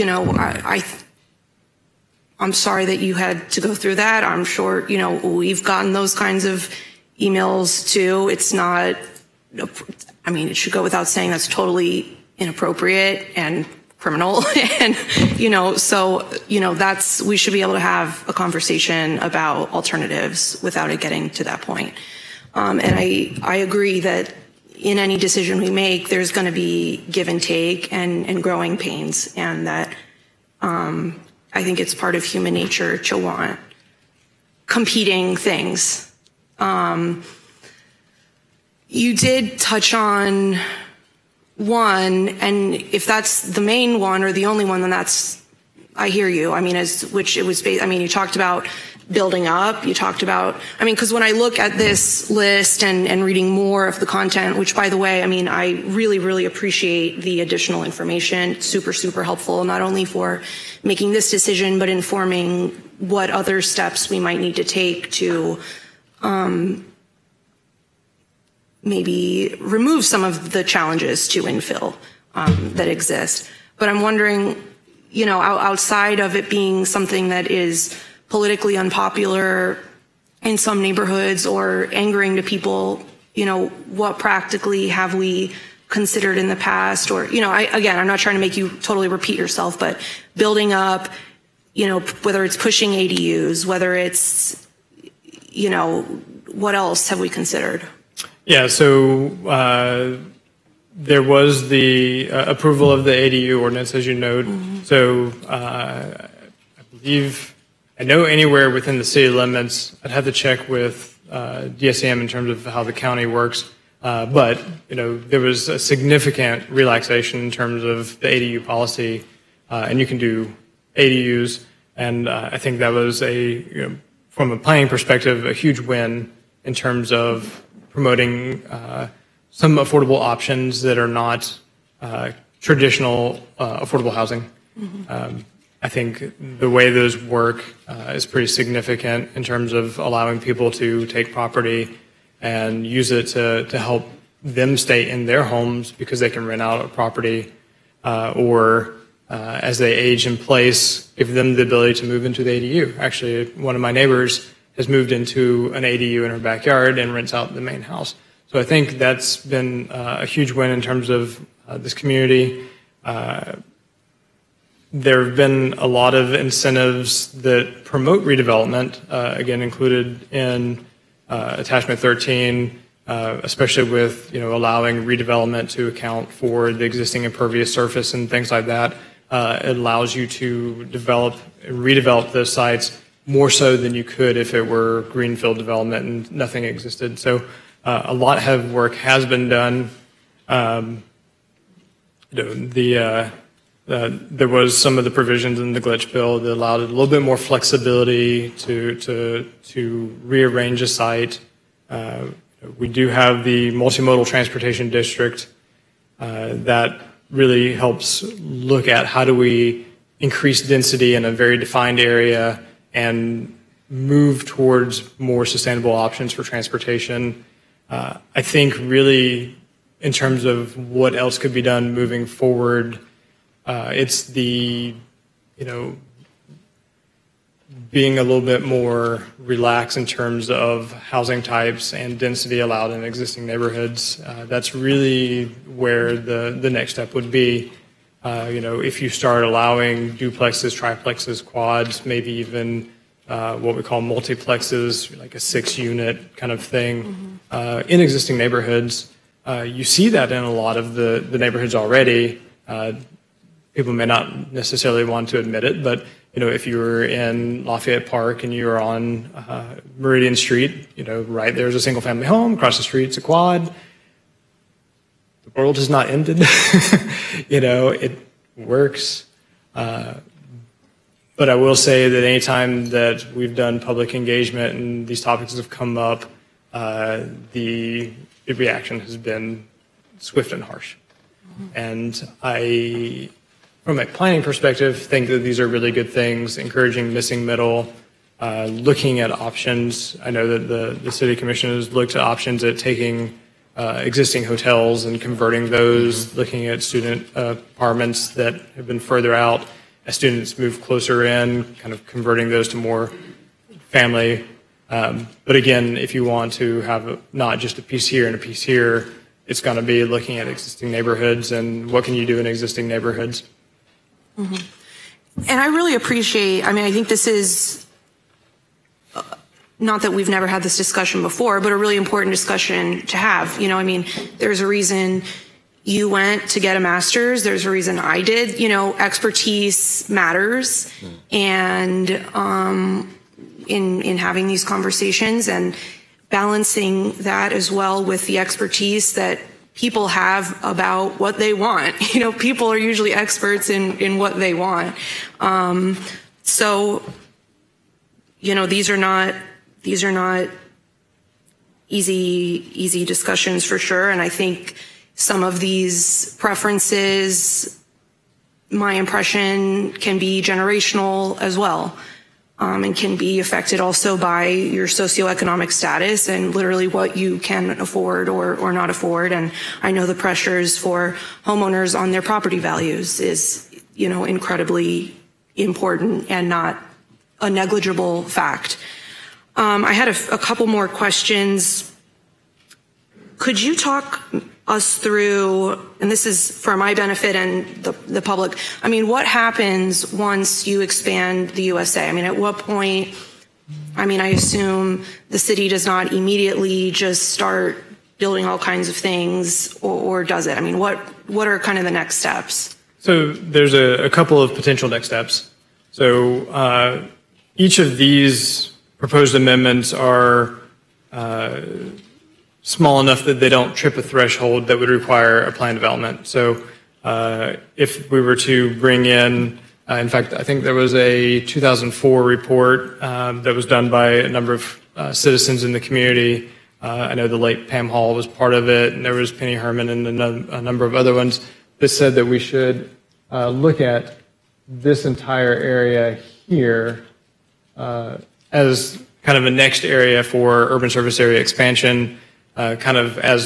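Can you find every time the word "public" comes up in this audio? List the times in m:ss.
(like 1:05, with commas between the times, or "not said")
4:33, 6:28.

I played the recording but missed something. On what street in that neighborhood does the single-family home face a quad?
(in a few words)
Meridian Street.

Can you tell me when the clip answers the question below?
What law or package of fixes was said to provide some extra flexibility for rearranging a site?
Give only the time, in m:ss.
3:15.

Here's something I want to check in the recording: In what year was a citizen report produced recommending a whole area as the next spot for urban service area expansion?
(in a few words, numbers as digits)
2004.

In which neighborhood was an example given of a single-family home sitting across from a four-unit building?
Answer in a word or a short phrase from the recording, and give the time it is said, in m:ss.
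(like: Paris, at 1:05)
Lafayette Park, at 4:17.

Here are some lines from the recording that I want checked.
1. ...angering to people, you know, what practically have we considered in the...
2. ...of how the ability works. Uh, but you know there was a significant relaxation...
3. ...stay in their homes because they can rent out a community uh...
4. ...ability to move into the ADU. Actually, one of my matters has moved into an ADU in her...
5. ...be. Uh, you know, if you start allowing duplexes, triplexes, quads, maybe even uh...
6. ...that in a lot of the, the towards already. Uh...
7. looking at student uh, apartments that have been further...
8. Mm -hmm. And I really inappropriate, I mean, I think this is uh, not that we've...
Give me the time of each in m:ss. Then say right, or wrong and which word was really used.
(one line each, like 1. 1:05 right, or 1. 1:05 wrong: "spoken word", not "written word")
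1. 1:21 right
2. 1:52 wrong: "county", not "ability"
3. 2:24 wrong: "property", not "community"
4. 2:31 wrong: "neighbors", not "matters"
5. 3:57 right
6. 4:10 wrong: "neighborhoods", not "towards"
7. 4:56 right
8. 5:14 wrong: "appreciate", not "inappropriate".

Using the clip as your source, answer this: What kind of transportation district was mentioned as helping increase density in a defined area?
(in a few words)
multimodal transportation district.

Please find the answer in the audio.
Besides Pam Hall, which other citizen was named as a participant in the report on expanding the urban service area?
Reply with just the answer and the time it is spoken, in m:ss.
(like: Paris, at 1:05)
Penny Herman, at 7:09.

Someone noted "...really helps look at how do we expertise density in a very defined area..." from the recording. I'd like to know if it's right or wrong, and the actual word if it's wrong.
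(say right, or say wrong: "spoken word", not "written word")
wrong: "increase", not "expertise".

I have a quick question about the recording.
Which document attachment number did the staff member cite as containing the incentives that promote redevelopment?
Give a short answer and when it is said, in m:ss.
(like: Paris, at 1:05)
13, at 2:51.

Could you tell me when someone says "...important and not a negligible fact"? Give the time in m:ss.
6:15.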